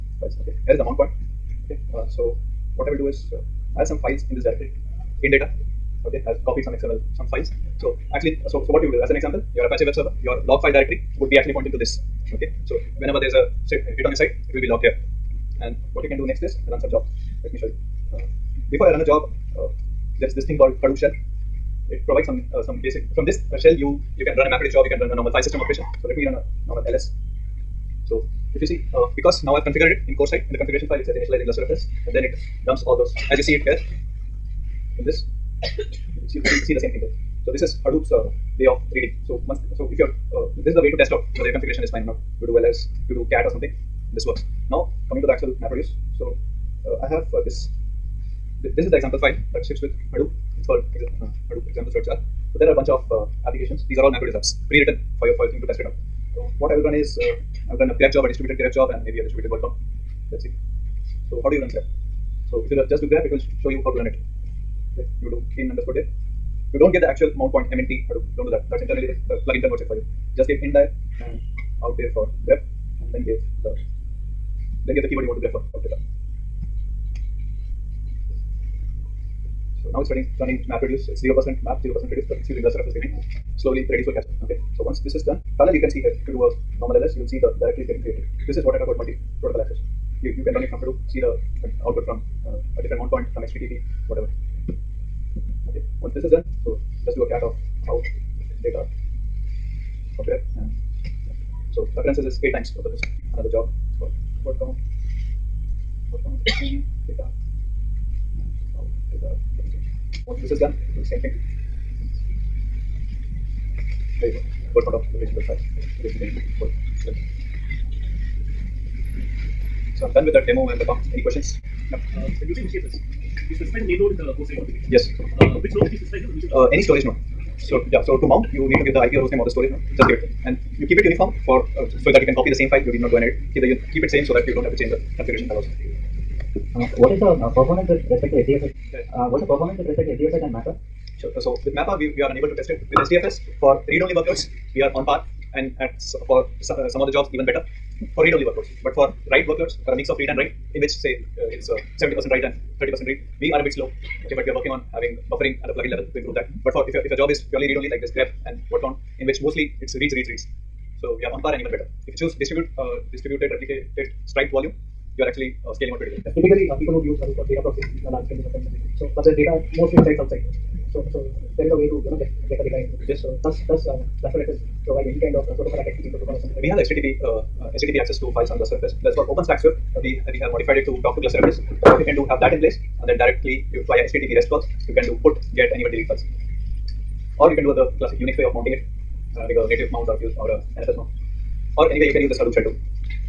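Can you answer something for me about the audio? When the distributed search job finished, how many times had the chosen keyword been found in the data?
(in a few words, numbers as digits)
8.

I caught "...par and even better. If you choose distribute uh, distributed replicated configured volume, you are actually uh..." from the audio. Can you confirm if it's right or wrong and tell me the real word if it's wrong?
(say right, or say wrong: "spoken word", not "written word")
wrong: "striped", not "configured".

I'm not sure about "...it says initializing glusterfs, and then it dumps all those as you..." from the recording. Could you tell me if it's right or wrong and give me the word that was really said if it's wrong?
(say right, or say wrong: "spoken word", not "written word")
right.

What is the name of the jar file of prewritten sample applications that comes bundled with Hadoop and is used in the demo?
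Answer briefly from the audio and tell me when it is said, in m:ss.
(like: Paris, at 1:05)
Hadoop examples.jar, at 0:51.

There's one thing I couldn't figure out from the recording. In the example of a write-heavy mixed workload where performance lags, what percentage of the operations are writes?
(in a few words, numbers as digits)
70%.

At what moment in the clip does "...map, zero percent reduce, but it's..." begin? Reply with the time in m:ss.
1:21.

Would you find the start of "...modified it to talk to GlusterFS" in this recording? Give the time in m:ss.
3:00.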